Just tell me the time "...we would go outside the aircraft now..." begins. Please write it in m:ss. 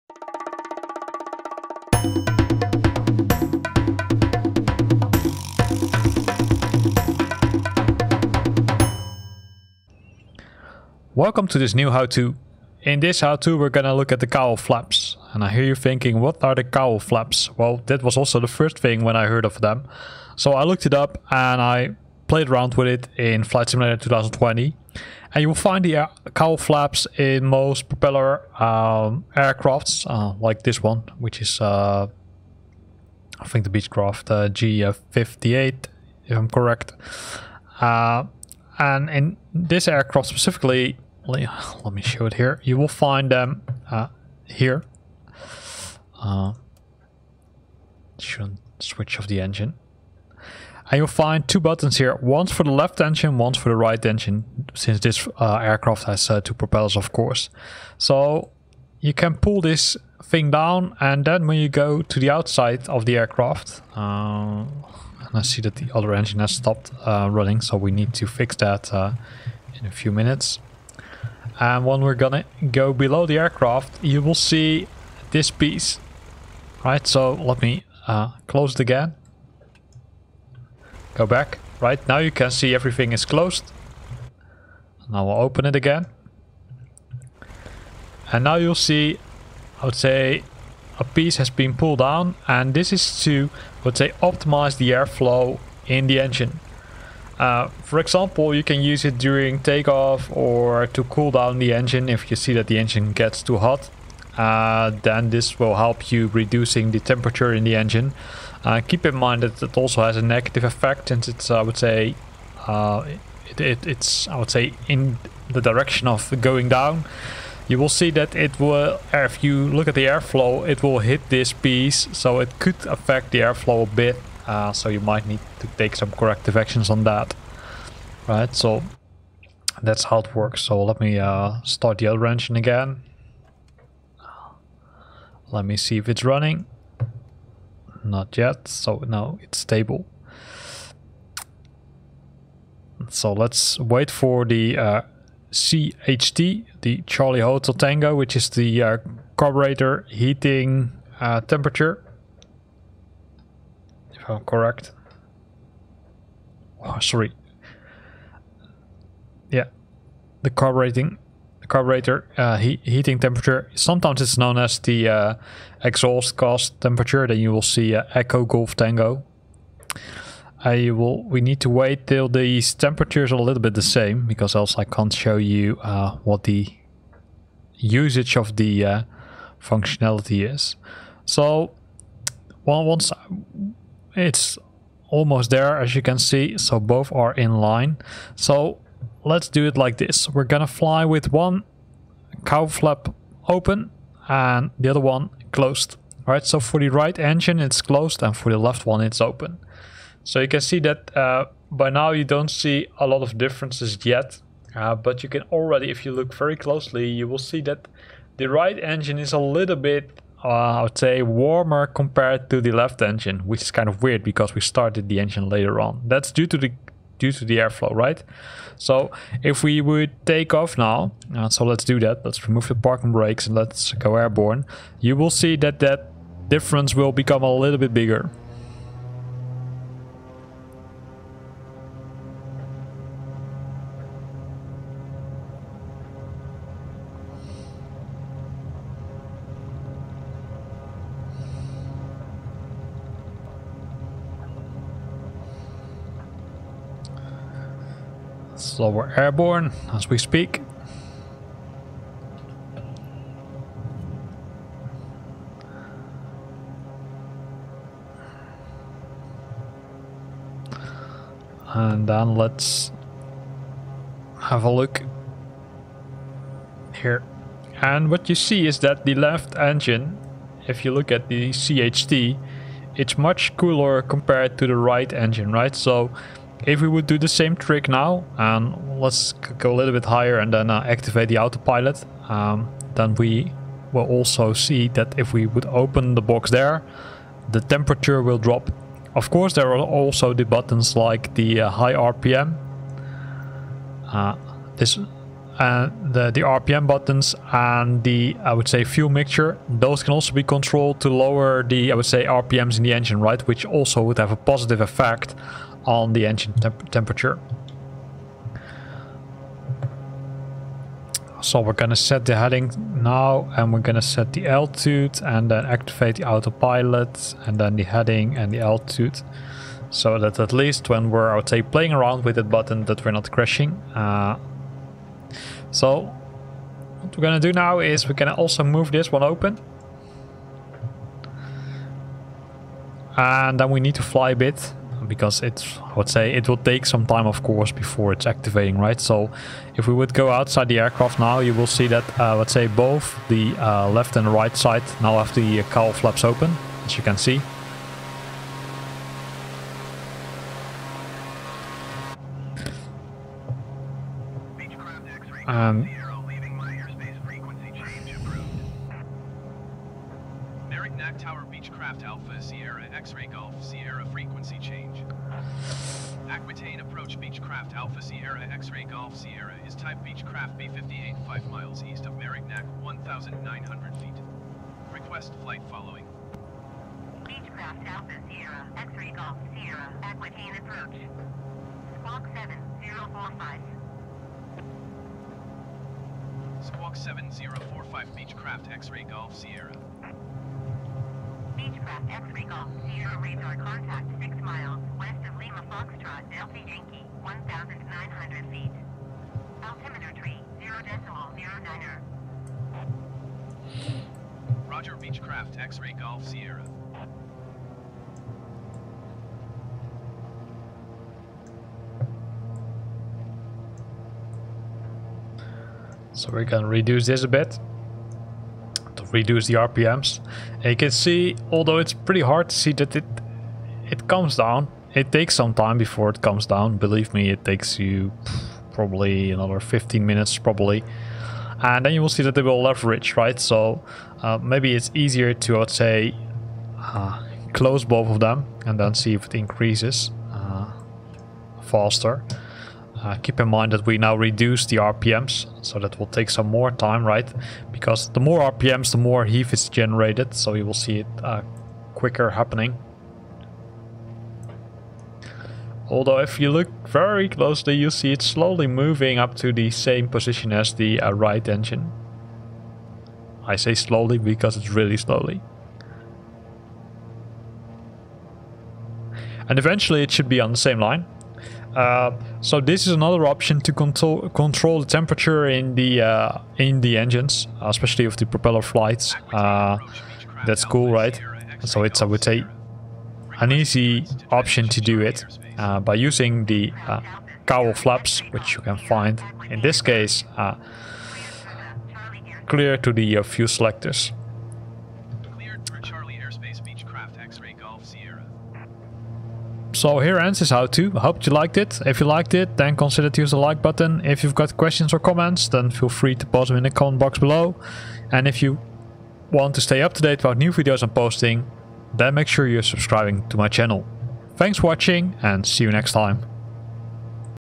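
5:39.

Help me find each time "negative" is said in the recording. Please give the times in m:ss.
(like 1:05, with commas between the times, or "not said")
1:50.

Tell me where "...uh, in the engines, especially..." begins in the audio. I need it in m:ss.
7:56.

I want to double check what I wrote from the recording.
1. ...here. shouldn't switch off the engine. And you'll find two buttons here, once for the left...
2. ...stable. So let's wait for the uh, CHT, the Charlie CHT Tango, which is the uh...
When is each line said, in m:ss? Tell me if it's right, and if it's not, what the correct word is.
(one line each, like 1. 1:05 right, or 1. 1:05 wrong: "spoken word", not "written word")
1. 0:44 right
2. 2:19 wrong: "Hotel", not "CHT".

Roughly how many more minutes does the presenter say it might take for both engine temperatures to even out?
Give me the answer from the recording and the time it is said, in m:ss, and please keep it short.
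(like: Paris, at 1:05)
15 minutes, at 7:09.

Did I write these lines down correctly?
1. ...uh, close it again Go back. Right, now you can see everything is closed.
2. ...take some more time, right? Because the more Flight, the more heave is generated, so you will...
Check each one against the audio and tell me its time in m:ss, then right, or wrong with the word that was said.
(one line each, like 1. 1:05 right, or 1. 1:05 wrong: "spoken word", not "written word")
1. 1:18 right
2. 7:26 wrong: "RPMs", not "Flight".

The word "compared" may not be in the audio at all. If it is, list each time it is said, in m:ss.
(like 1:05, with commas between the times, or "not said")
3:31, 4:34.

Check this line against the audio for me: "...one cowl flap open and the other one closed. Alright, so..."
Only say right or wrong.
right.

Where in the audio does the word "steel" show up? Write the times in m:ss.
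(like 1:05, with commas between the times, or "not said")
not said.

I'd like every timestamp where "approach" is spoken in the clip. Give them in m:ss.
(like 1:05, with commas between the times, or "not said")
6:06, 6:20.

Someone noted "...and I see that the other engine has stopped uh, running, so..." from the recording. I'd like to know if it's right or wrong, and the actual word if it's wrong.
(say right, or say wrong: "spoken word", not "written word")
right.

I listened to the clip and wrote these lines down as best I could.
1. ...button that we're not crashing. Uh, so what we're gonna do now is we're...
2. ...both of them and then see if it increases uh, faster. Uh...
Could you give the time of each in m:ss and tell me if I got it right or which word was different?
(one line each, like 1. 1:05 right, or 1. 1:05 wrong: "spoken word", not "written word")
1. 5:22 right
2. 7:17 right.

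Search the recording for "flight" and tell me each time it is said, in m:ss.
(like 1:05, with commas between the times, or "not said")
0:23, 6:15, 7:58.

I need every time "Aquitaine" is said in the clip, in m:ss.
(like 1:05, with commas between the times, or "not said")
6:06, 6:20.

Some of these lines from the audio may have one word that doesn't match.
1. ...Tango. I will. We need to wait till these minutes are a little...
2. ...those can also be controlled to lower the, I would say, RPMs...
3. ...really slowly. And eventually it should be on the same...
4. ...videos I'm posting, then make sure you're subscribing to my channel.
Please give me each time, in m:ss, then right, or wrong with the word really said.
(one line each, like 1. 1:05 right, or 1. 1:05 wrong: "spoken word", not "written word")
1. 2:48 wrong: "temperatures", not "minutes"
2. 4:59 right
3. 7:44 right
4. 8:30 right.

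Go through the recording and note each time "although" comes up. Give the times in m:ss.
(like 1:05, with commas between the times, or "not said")
7:01, 7:35.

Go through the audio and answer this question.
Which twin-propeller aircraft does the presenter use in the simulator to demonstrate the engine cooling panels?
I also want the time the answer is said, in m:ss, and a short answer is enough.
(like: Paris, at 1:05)
Beechcraft G58, at 0:33.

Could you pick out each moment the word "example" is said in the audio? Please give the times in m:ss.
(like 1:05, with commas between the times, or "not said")
1:37.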